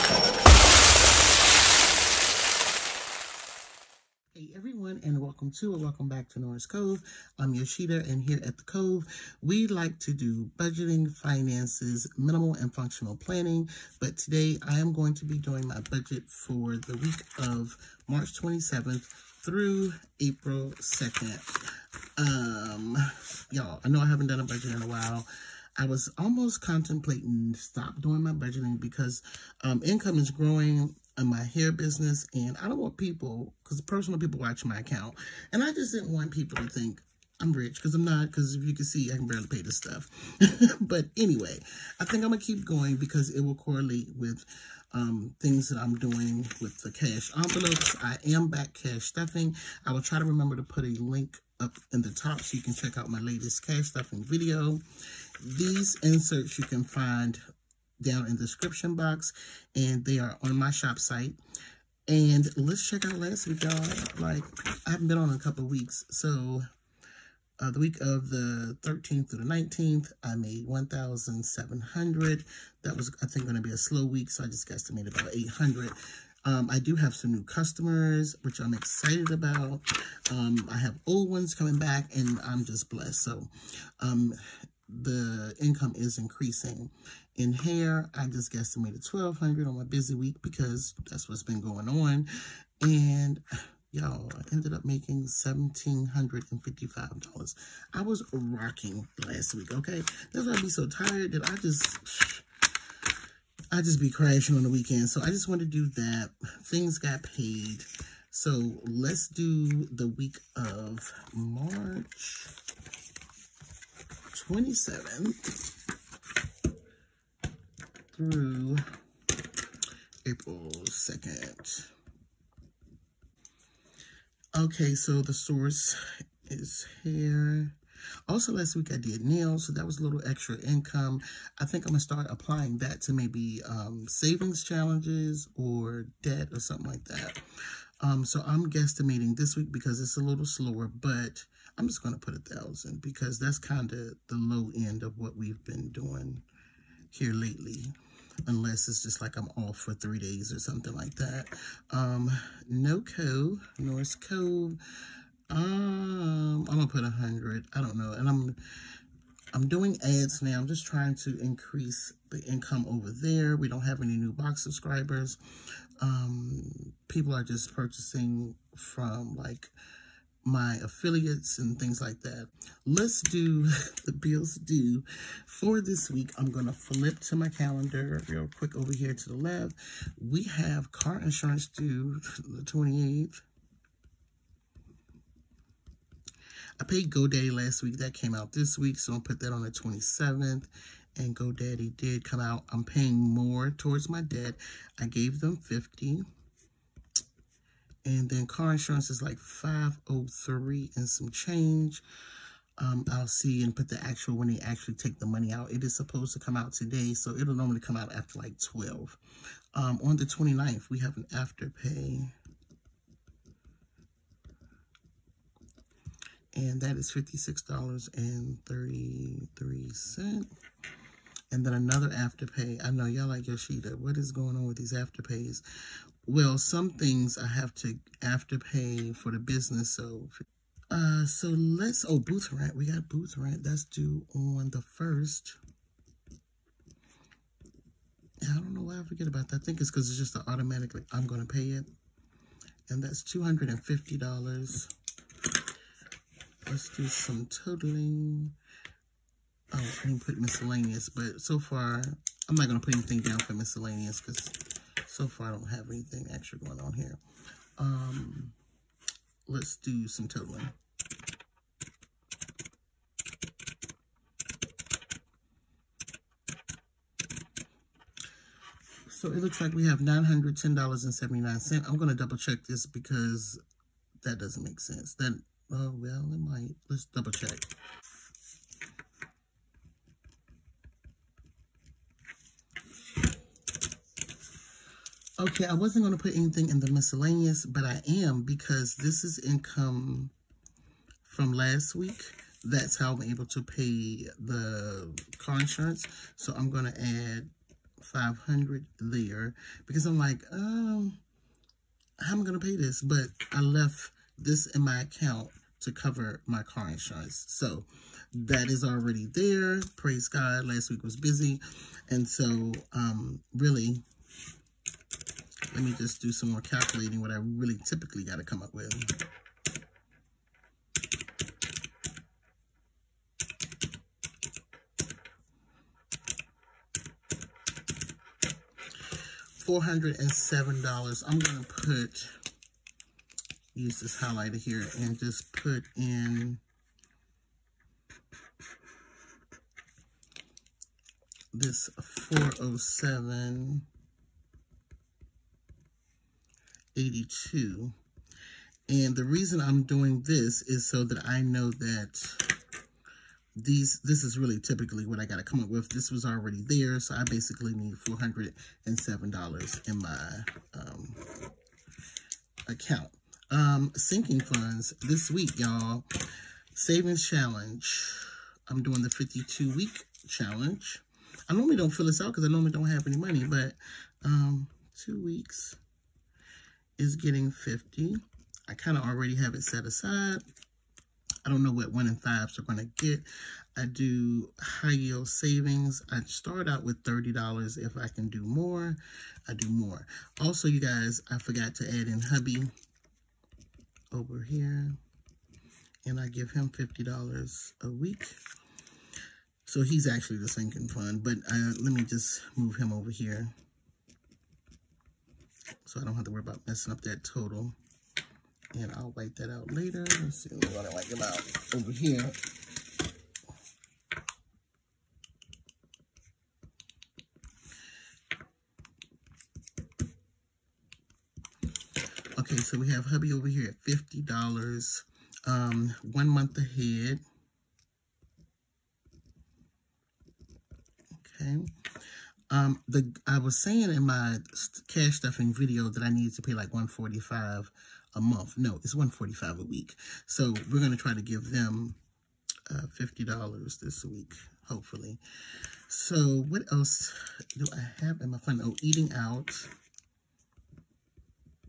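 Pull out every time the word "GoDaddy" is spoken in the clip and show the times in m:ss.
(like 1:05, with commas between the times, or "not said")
3:07, 3:11.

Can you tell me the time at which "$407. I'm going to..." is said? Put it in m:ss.
5:29.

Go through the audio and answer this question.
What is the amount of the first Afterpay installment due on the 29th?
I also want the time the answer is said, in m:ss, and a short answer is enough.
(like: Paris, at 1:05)
$56.33, at 3:37.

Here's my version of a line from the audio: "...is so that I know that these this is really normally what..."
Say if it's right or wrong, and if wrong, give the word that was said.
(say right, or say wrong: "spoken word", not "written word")
wrong: "typically", not "normally".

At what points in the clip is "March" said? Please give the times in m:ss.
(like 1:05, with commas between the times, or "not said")
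0:18, 1:51.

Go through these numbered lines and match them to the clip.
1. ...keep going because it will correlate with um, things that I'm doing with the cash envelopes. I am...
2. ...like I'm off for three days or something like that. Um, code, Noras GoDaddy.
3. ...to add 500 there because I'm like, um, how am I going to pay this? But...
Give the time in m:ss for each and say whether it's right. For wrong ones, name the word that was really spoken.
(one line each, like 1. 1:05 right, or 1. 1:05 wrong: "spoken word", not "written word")
1. 0:42 right
2. 2:29 wrong: "Cove", not "GoDaddy"
3. 4:56 right.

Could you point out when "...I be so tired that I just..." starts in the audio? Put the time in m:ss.
1:40.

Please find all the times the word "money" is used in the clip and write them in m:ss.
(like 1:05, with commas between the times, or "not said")
3:25, 6:13.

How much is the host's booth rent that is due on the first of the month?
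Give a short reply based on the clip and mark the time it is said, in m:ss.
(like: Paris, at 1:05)
$250, at 4:03.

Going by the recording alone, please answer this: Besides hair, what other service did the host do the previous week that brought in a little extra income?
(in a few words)
nails.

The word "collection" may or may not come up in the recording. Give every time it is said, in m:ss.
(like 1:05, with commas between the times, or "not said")
not said.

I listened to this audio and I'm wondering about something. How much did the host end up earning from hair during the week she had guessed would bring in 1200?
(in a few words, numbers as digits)
$1,755.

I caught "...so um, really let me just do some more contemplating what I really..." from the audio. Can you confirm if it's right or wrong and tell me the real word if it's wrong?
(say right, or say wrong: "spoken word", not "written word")
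wrong: "calculating", not "contemplating".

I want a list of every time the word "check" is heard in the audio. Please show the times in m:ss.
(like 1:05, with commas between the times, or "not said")
0:52, 1:02, 4:32, 4:37.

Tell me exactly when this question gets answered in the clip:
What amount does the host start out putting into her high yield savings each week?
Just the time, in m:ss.
6:27.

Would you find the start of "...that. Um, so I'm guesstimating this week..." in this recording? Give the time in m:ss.
2:17.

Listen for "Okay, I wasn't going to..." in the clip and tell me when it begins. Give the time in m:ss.
4:45.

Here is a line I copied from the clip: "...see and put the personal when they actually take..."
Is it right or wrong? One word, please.
wrong.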